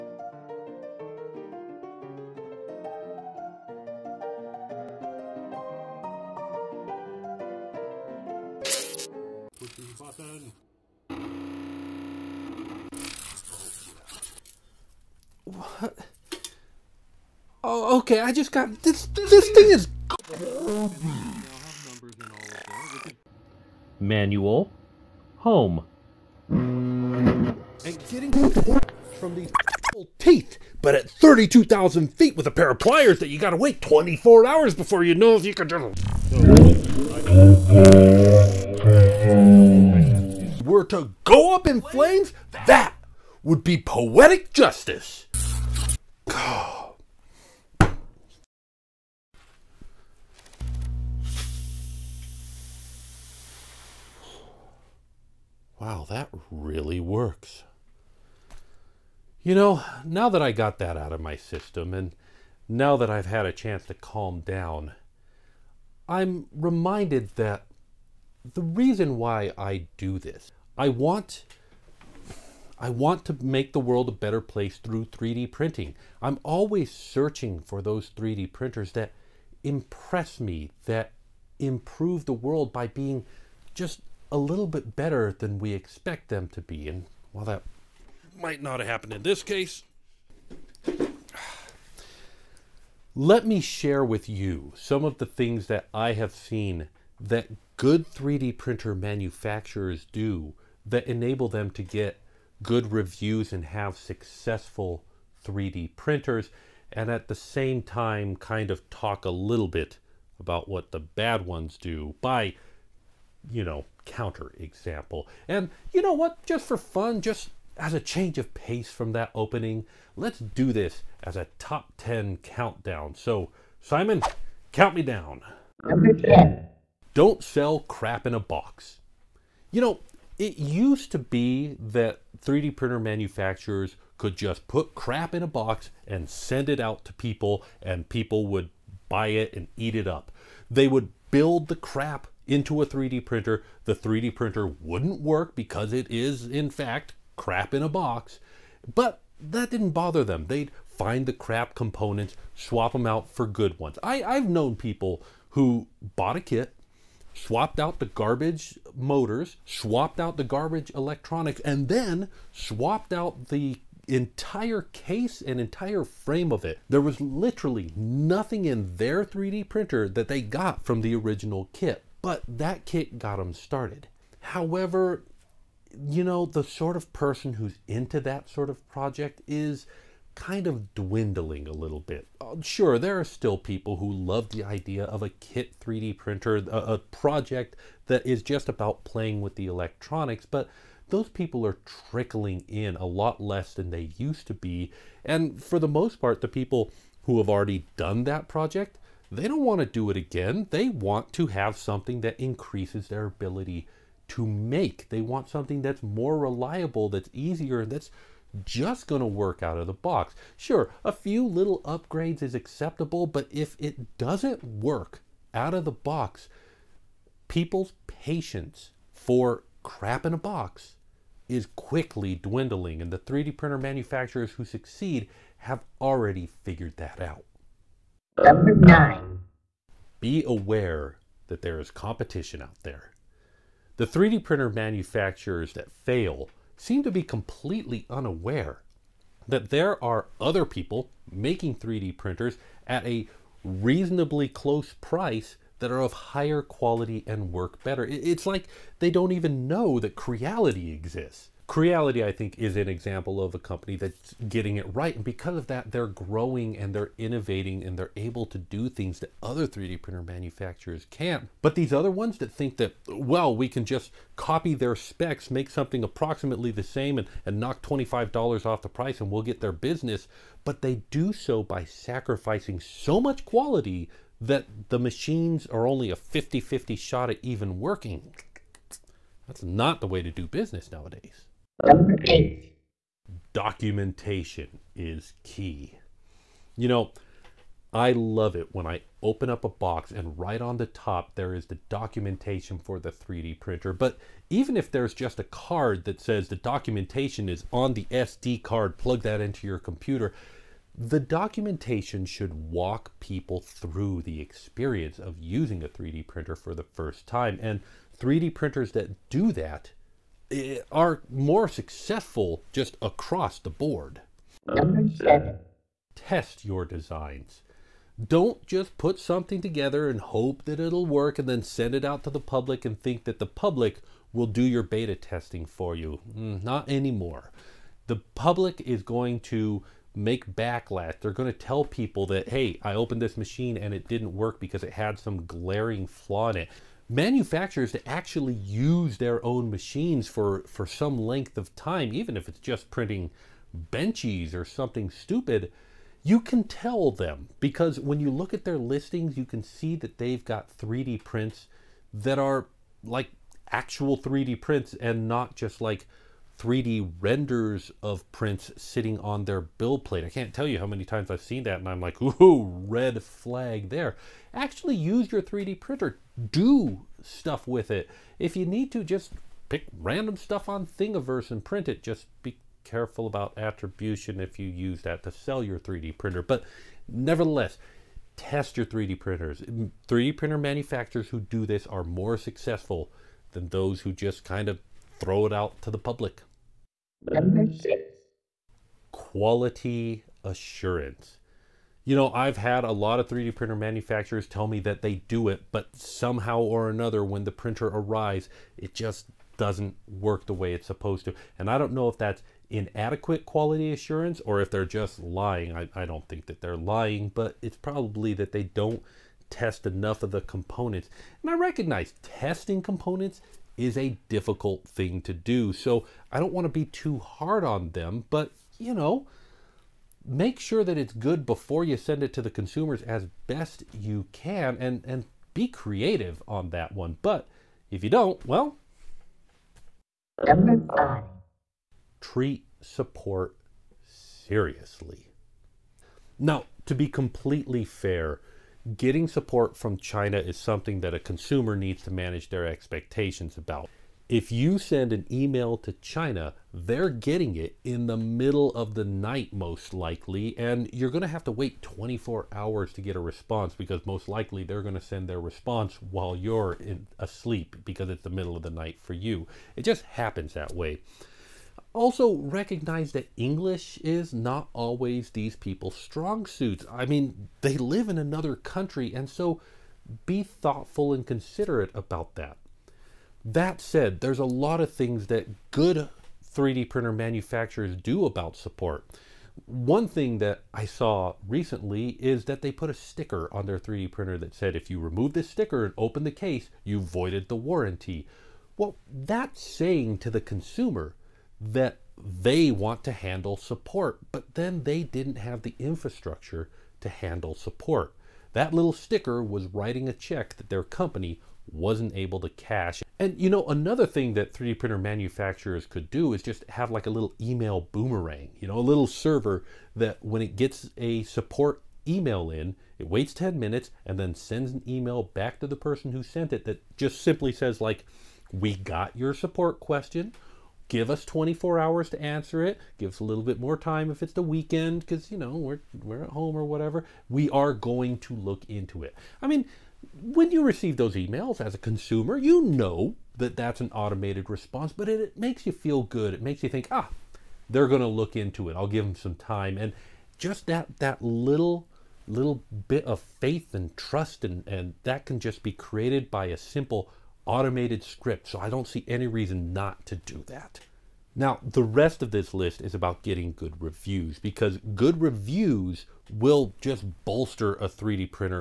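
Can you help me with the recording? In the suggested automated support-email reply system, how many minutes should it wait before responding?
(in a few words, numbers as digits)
10 minutes.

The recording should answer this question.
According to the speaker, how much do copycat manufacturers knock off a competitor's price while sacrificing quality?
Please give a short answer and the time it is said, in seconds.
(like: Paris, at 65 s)
$25, at 267 s.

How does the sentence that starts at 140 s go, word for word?
They would build the crap into a 3D printer.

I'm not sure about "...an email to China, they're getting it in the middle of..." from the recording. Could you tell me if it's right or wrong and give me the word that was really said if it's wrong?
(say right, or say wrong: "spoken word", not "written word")
right.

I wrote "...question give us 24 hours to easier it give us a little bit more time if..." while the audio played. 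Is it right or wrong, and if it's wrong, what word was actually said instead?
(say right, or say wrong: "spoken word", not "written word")
wrong: "answer", not "easier".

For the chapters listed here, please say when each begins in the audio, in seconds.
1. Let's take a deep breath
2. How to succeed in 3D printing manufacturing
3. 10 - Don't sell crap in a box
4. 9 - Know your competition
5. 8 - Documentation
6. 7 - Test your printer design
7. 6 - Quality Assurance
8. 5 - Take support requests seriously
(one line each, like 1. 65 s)
1. 47 s
2. 94 s
3. 125 s
4. 227 s
5. 281 s
6. 314 s
7. 386 s
8. 429 s.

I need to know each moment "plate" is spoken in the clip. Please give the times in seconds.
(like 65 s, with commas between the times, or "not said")
360 s.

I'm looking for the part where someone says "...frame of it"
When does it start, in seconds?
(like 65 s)
166 s.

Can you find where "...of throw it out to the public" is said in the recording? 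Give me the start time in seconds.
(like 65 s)
384 s.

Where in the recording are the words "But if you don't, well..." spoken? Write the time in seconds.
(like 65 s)
427 s.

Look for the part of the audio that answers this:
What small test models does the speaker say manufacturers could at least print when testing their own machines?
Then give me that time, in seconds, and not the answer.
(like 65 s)
343 s.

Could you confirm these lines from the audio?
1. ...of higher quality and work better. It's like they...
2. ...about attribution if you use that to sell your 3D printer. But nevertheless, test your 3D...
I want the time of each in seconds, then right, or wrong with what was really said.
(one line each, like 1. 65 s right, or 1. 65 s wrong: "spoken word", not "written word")
1. 246 s right
2. 373 s right.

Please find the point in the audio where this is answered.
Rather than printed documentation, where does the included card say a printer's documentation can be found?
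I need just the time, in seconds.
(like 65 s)
297 s.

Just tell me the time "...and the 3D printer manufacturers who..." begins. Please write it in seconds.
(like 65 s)
223 s.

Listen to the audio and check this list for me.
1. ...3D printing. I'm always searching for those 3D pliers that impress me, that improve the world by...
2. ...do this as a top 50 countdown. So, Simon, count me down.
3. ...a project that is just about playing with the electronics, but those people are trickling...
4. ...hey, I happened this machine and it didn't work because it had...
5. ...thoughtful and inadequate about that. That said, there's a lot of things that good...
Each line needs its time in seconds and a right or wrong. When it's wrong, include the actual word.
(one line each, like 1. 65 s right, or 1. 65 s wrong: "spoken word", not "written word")
1. 75 s wrong: "printers", not "pliers"
2. 120 s wrong: "10", not "50"
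3. 186 s right
4. 332 s wrong: "opened", not "happened"
5. 470 s wrong: "considerate", not "inadequate".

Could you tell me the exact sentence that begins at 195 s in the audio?
And for the most part, the people who have already done that project, they don't want to do it again.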